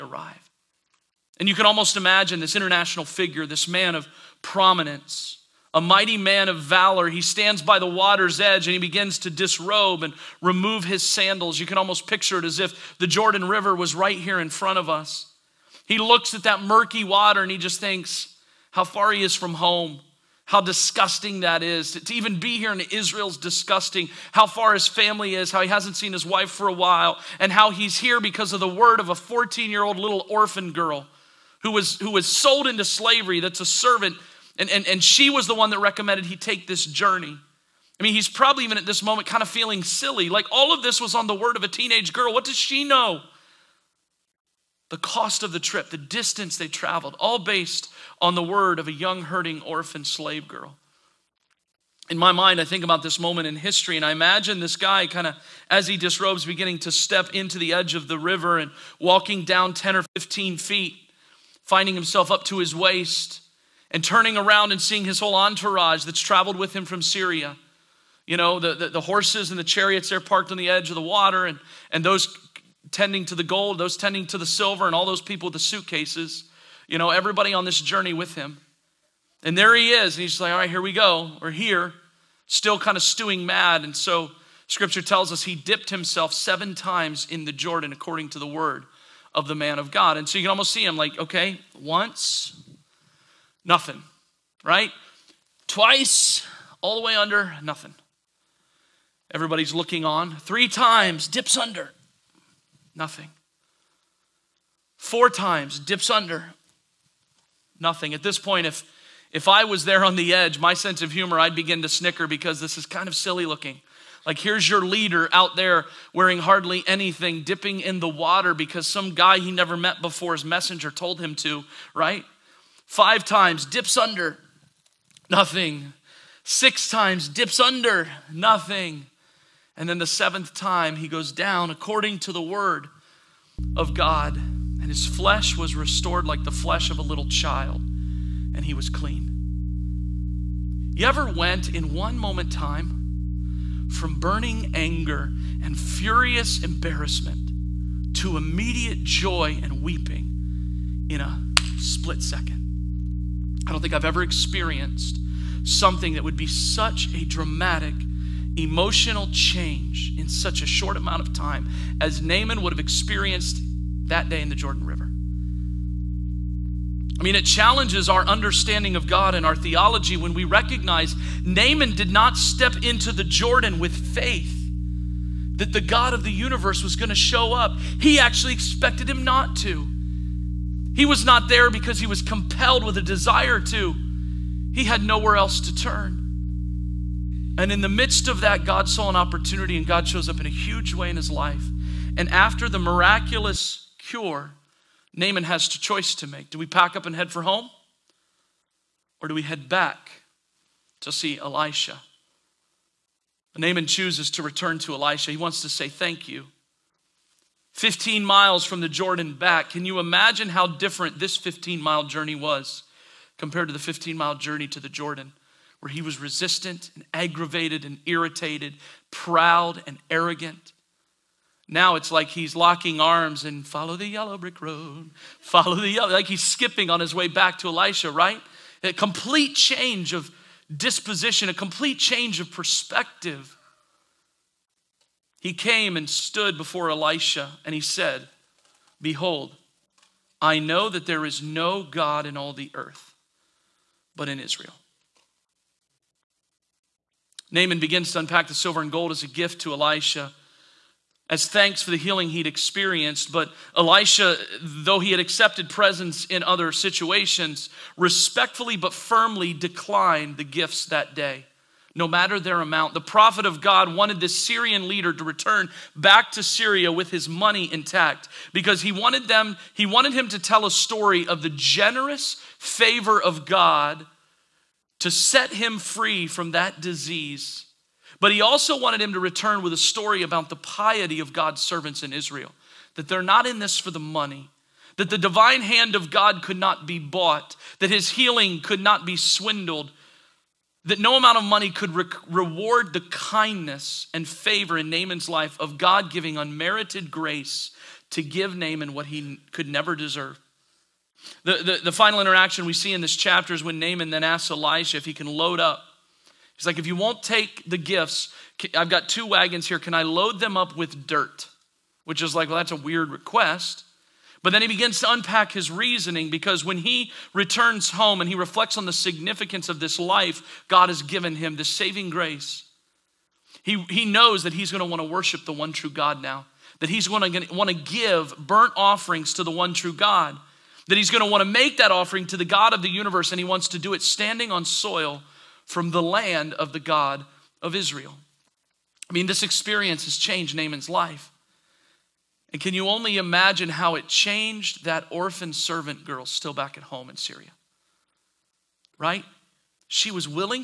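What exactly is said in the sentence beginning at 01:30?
And so you can almost see him like, okay, once, Nothing, right?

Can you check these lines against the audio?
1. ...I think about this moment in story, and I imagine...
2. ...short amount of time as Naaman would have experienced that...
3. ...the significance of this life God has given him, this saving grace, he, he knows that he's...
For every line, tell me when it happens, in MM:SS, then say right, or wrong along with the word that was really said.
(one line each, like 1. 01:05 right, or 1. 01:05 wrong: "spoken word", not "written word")
1. 00:52 wrong: "history", not "story"
2. 02:40 right
3. 05:18 right.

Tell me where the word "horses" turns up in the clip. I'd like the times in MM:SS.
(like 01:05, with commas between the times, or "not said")
01:09.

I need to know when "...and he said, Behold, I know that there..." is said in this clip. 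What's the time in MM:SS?
03:57.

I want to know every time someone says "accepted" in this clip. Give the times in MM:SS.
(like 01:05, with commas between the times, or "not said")
04:15.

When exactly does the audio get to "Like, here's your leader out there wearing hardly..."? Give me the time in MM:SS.
01:54.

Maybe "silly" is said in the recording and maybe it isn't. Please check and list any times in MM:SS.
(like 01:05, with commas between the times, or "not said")
00:39, 01:53.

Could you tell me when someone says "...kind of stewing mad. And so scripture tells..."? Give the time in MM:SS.
01:22.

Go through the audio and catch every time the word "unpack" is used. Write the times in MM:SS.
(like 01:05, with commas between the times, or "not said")
04:08, 05:15.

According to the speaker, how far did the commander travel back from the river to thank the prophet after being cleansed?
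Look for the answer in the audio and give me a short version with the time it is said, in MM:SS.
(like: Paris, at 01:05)
15 miles, at 03:27.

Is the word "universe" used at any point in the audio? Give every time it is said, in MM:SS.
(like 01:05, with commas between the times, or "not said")
02:56, 05:32.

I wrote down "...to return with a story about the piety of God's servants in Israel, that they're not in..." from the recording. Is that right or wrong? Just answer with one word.
right.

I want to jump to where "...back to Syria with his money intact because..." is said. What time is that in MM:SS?
04:25.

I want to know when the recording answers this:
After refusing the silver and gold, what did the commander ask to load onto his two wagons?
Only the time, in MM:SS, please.
05:11.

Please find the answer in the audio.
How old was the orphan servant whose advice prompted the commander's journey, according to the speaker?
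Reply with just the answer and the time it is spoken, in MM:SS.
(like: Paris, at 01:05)
14, at 00:29.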